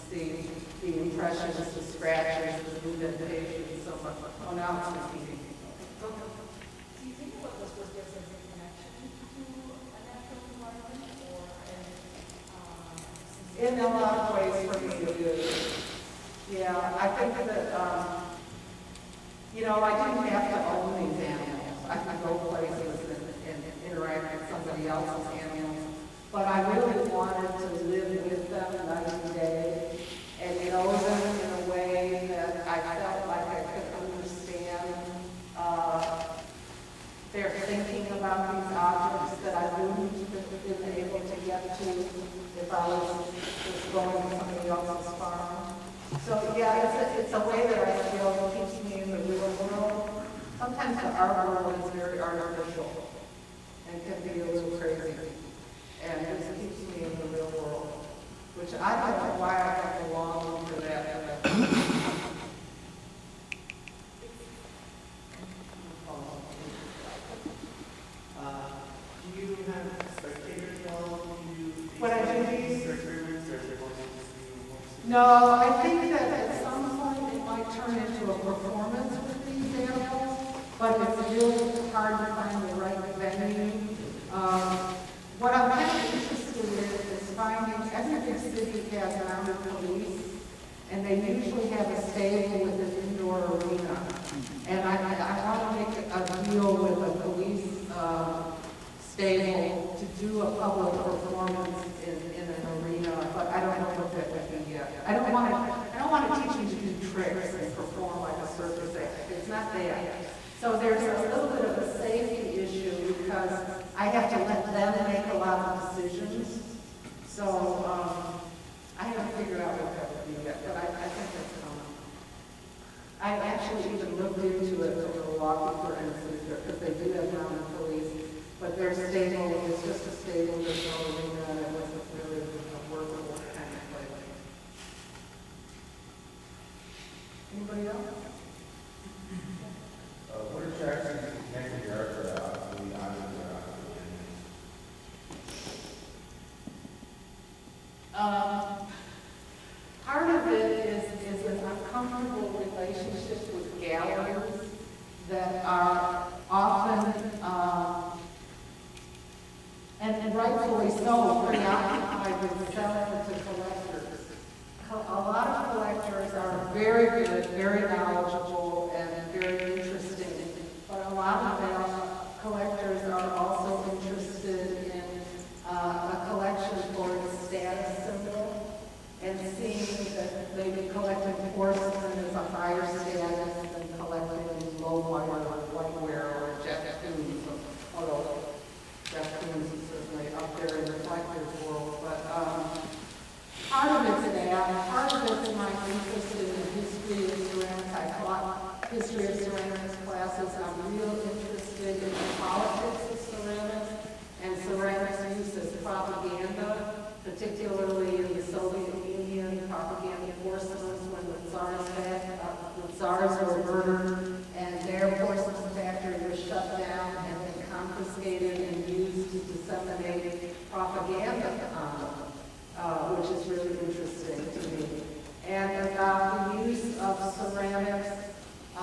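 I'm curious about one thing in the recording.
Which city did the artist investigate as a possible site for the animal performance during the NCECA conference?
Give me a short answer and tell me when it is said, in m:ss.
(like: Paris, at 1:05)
Milwaukee, at 2:05.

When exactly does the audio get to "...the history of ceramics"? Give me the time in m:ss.
3:16.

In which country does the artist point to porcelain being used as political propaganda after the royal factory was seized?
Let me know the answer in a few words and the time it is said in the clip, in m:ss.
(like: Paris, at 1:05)
Soviet Union, at 3:28.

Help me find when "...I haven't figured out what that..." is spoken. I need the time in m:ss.
1:58.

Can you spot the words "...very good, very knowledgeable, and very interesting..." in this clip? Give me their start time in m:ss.
2:46.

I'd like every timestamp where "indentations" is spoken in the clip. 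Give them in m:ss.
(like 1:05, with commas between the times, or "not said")
0:02.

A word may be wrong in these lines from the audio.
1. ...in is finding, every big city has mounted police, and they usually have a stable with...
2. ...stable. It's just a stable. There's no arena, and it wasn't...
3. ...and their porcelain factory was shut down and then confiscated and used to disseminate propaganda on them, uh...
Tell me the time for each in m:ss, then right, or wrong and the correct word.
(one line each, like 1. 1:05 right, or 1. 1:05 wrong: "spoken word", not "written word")
1. 1:26 right
2. 2:08 right
3. 3:34 right.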